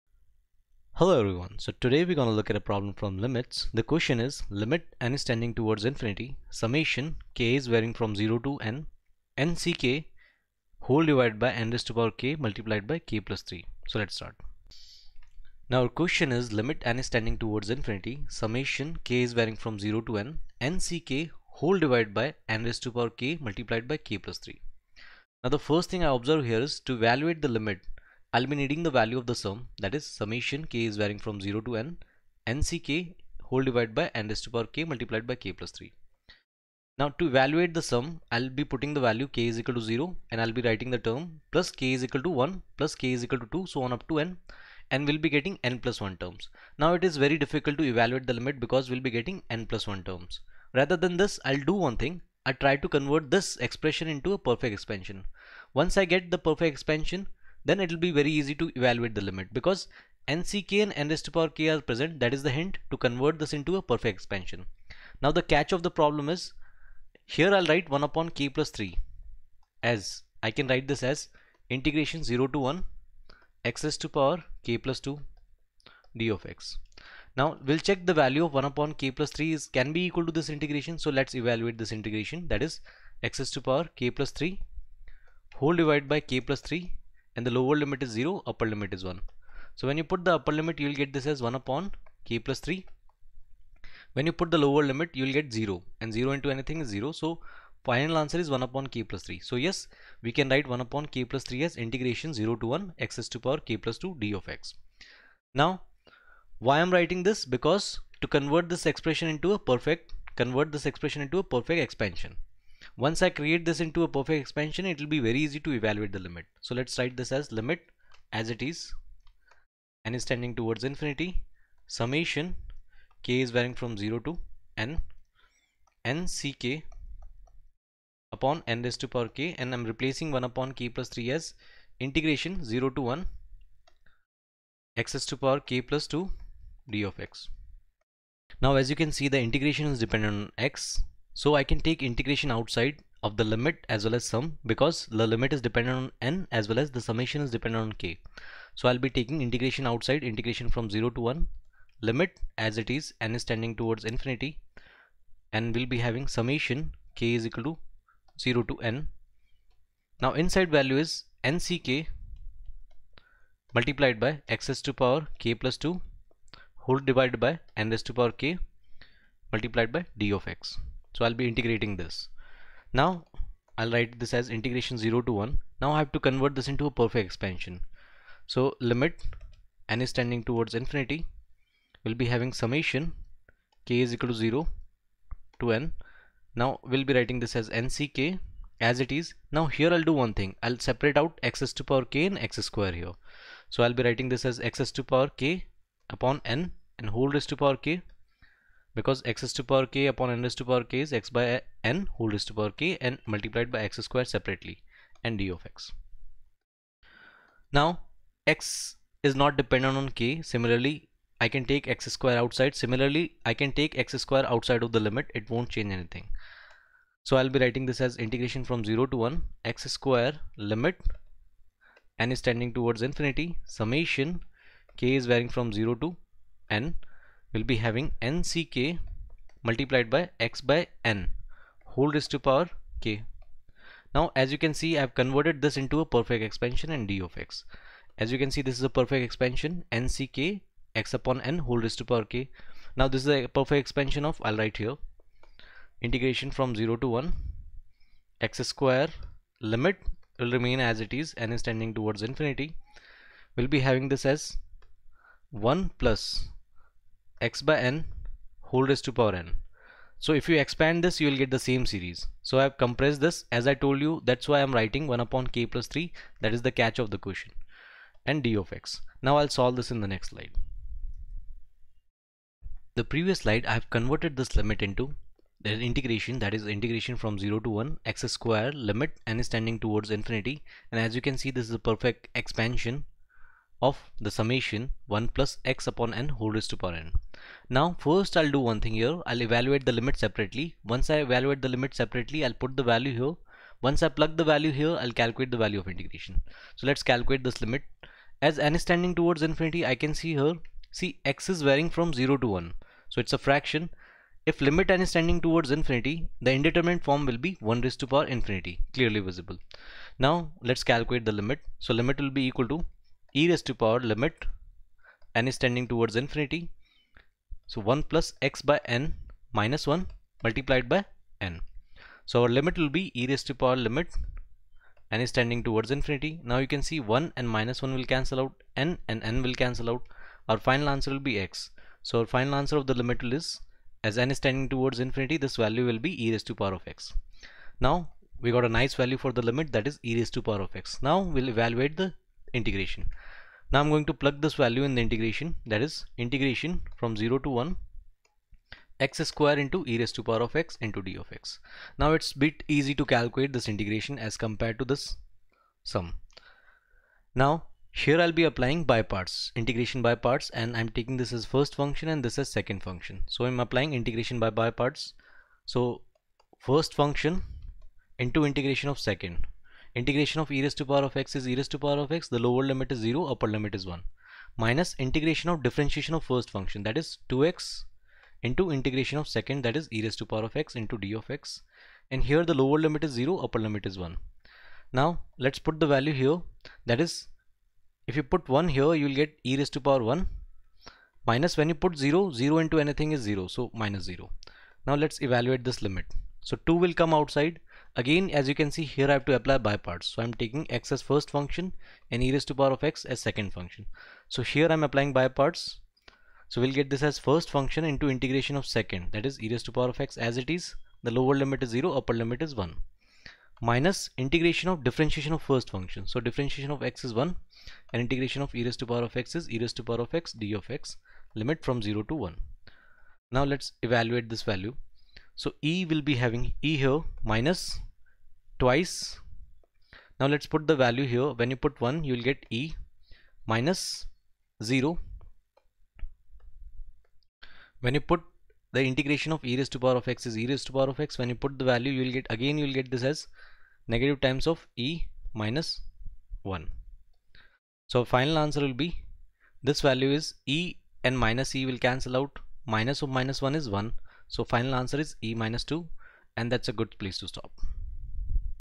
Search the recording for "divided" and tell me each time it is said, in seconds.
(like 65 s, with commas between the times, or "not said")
11 s, 21 s, 33 s, 85 s, 166 s.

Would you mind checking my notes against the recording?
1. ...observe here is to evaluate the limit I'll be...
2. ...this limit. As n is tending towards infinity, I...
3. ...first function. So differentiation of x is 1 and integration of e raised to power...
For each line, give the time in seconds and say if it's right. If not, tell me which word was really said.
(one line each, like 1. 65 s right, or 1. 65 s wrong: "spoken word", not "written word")
1. 26 s right
2. 297 s right
3. 415 s right.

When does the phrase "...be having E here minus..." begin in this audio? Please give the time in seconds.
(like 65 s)
426 s.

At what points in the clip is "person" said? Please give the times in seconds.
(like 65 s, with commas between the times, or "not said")
not said.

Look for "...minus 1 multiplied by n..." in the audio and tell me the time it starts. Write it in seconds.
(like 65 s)
319 s.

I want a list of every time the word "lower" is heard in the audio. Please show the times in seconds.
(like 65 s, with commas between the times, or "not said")
87 s, 94 s, 372 s, 382 s, 411 s.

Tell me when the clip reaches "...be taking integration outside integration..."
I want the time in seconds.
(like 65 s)
148 s.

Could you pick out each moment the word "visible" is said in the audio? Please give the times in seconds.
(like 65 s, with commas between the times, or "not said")
309 s.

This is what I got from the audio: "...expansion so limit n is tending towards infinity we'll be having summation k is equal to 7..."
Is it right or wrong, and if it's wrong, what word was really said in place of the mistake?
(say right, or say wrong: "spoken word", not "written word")
wrong: "0", not "7".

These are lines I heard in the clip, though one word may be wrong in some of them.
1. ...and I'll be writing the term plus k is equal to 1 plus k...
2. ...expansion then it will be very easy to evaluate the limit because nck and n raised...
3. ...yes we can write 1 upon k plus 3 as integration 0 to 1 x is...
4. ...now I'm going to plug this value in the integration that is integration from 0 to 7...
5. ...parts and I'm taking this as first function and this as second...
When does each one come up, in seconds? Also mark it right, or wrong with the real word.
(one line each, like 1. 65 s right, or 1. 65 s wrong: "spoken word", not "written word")
1. 40 s right
2. 56 s right
3. 99 s right
4. 343 s wrong: "1", not "7"
5. 360 s right.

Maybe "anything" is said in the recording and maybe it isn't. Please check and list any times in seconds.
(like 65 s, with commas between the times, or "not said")
96 s, 215 s, 392 s.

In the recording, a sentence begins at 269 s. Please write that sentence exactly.
Now I'll solve this in the next slide.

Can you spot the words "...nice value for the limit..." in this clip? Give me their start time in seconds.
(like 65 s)
338 s.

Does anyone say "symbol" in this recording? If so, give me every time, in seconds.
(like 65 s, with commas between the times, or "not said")
not said.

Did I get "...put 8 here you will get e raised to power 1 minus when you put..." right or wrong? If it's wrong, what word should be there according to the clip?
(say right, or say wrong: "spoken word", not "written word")
wrong: "1", not "8".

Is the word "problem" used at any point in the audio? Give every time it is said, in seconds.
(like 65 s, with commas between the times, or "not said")
2 s, 65 s.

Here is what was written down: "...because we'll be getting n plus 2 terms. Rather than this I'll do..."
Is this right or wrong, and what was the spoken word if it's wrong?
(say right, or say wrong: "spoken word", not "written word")
wrong: "1", not "2".